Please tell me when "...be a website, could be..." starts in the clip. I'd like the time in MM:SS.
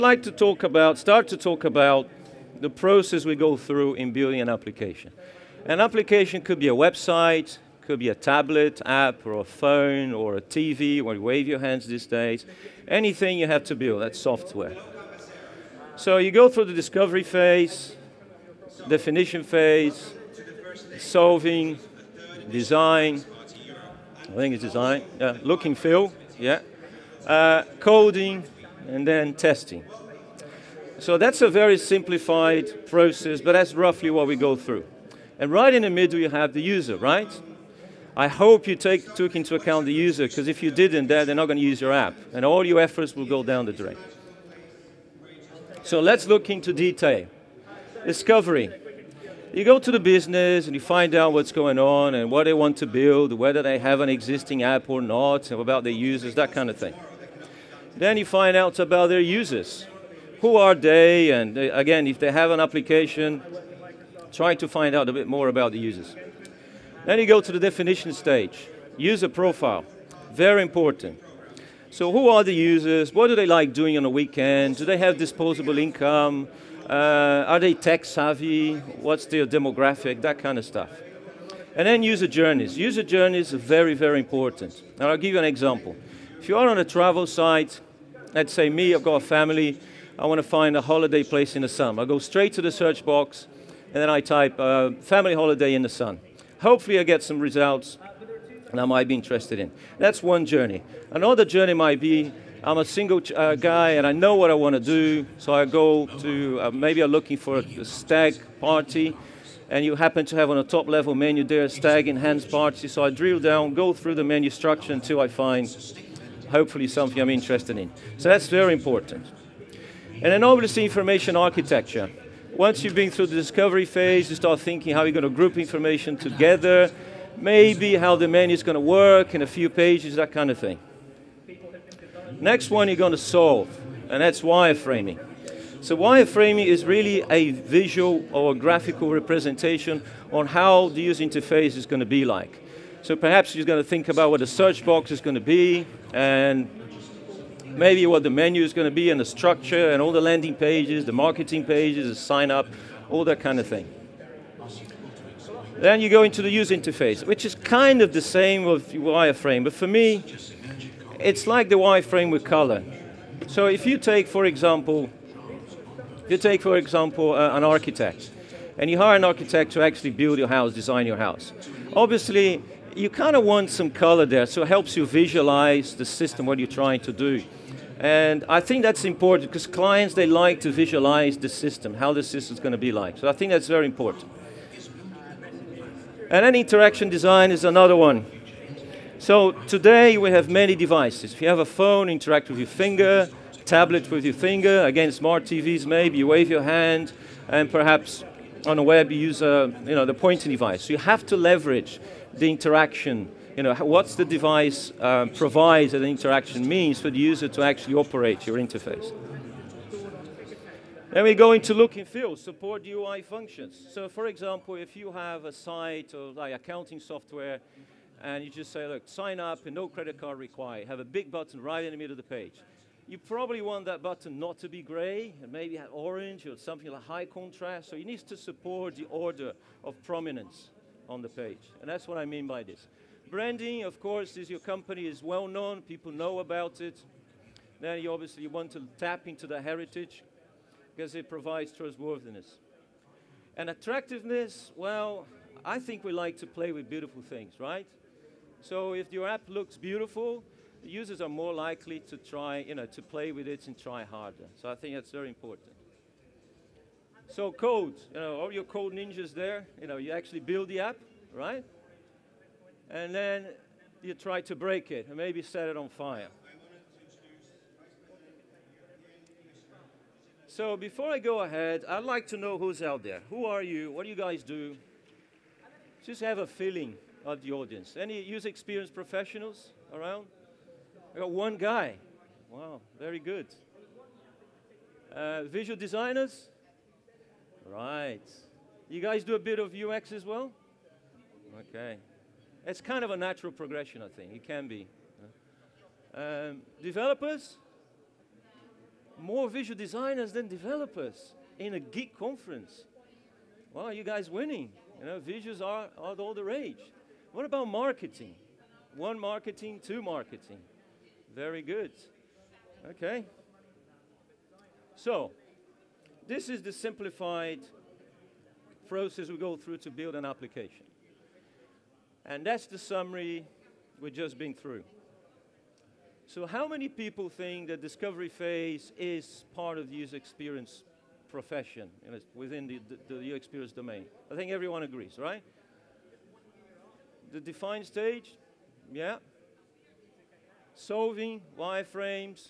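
00:06.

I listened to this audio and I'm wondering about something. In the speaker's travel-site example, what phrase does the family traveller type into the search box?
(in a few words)
family holiday in the sun.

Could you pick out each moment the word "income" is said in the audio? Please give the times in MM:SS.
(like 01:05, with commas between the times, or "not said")
01:15.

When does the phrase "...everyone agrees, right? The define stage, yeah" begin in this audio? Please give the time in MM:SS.
05:34.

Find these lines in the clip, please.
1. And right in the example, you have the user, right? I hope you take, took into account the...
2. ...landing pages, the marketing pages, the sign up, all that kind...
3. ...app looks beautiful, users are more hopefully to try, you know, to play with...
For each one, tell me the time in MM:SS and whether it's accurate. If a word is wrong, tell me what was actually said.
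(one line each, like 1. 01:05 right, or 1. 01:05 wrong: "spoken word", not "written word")
1. 00:35 wrong: "middle", not "example"
2. 02:30 right
3. 04:09 wrong: "likely", not "hopefully".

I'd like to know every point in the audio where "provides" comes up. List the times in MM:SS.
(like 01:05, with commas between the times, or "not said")
03:25, 04:01.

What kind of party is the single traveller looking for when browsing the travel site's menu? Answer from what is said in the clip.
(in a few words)
stag party.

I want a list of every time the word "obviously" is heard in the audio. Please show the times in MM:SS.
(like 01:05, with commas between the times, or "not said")
02:00, 02:51, 03:58.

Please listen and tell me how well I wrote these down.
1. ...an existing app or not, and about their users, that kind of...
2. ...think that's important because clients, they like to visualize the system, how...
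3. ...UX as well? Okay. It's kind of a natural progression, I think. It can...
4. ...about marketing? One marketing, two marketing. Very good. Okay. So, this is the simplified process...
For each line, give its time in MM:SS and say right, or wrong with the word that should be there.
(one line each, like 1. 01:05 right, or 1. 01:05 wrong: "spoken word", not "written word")
1. 00:53 right
2. 02:58 right
3. 04:49 right
4. 05:07 right.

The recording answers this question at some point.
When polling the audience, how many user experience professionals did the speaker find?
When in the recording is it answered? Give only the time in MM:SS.
04:41.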